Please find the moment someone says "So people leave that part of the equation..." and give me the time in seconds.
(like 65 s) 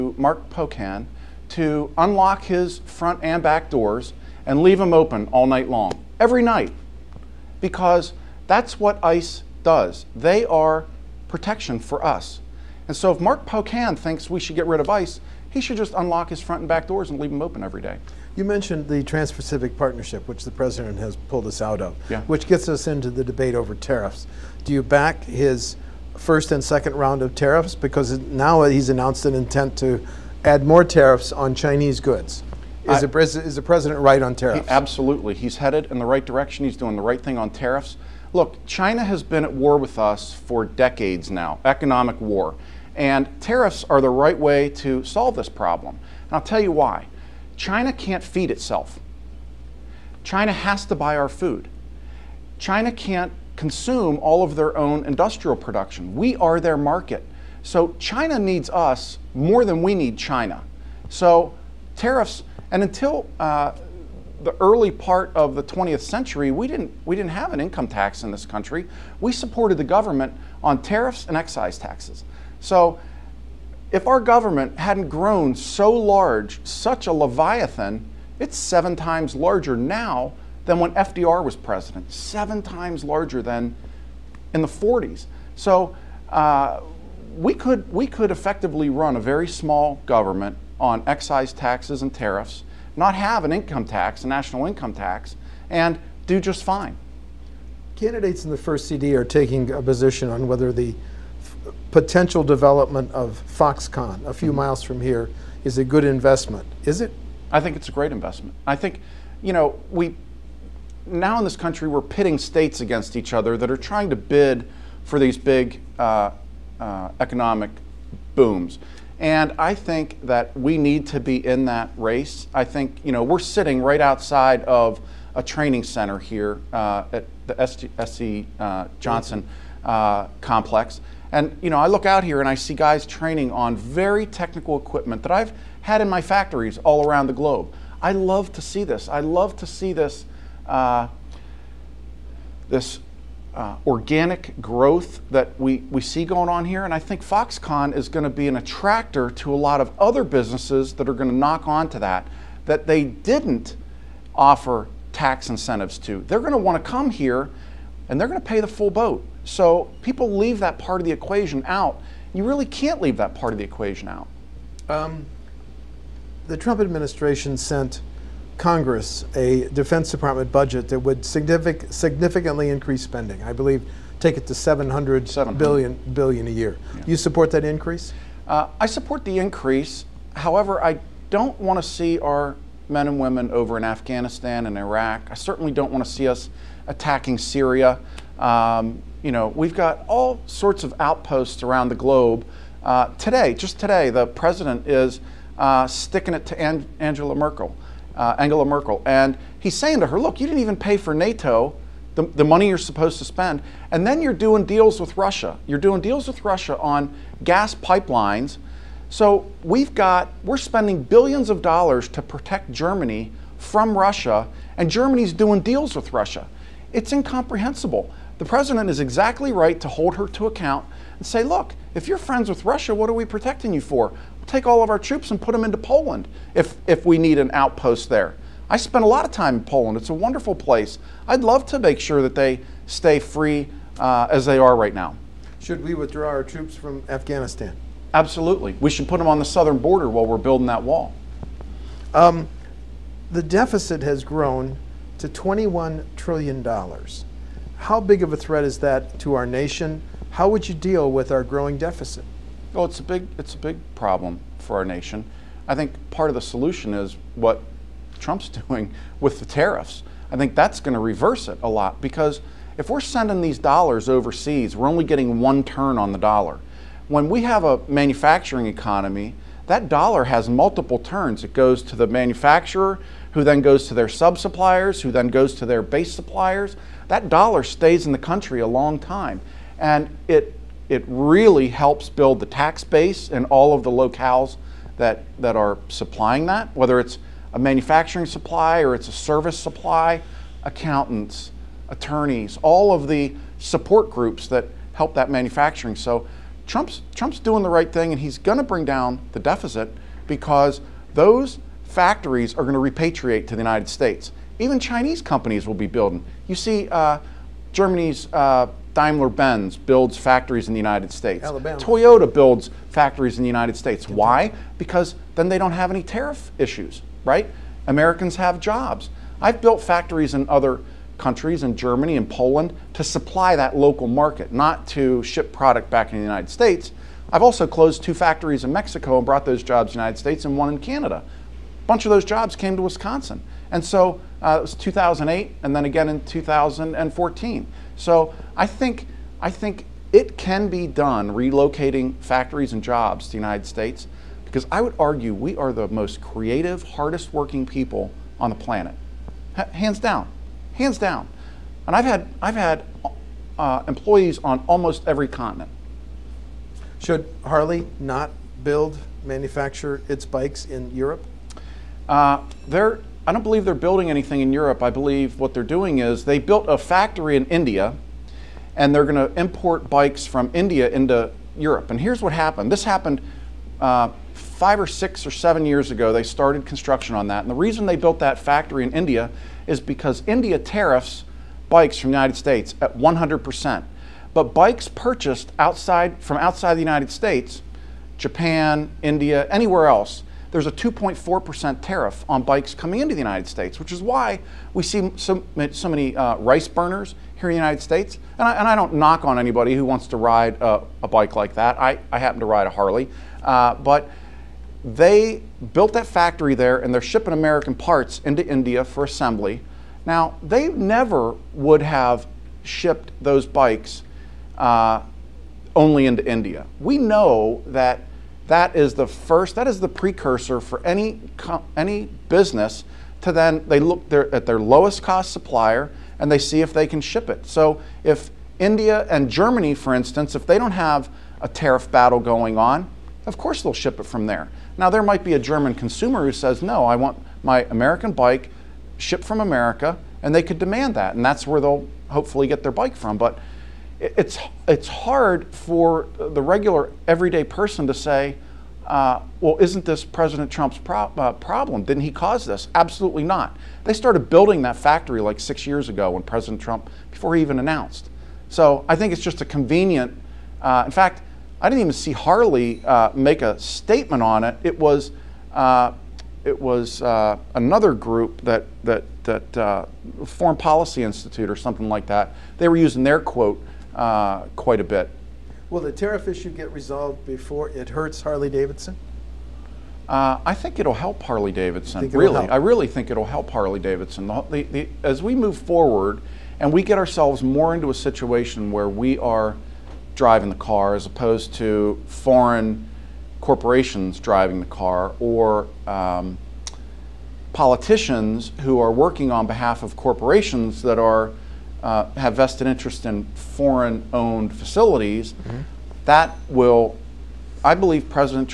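159 s.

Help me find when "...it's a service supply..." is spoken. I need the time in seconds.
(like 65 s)
288 s.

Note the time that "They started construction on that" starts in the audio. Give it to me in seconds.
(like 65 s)
376 s.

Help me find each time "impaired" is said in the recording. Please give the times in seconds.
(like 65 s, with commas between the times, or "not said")
not said.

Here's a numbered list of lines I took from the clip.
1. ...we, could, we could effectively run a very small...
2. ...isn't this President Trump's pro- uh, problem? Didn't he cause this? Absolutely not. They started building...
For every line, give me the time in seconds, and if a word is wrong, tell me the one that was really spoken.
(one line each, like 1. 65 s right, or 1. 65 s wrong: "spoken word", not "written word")
1. 87 s right
2. 449 s right.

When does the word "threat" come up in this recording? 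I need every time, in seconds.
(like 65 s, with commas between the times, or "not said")
248 s.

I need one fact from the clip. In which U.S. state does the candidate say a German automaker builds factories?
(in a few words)
Alabama.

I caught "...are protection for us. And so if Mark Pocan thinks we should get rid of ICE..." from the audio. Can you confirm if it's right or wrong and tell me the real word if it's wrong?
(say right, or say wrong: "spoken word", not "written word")
right.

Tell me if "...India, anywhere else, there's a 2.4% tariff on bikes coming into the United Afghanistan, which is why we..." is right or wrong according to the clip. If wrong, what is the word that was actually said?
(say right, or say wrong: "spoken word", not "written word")
wrong: "States", not "Afghanistan".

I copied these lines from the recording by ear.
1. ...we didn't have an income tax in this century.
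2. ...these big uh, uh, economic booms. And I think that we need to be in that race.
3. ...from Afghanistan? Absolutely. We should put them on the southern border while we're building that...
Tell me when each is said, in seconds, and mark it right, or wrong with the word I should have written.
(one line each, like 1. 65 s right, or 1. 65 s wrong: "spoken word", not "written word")
1. 67 s wrong: "country", not "century"
2. 115 s right
3. 236 s right.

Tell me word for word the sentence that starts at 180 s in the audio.
However, I don't want to see our men and women over in Afghanistan and Iraq.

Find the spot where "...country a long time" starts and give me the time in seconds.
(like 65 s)
278 s.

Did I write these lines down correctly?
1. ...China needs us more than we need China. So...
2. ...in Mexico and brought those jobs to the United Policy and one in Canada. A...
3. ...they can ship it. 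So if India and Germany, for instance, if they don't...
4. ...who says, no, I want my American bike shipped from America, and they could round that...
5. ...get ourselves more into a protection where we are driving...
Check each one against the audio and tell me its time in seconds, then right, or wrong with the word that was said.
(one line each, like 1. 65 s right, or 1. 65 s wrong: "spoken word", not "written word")
1. 57 s right
2. 328 s wrong: "States", not "Policy"
3. 426 s right
4. 436 s wrong: "demand", not "round"
5. 486 s wrong: "situation", not "protection".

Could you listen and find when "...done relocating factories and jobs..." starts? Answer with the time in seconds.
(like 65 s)
340 s.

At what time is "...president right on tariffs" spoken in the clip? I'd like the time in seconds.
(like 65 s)
33 s.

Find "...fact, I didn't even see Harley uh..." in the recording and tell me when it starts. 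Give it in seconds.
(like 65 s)
460 s.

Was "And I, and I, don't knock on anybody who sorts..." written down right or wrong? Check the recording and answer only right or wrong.
wrong.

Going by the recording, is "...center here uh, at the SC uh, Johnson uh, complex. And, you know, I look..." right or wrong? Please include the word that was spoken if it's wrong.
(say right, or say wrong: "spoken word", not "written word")
right.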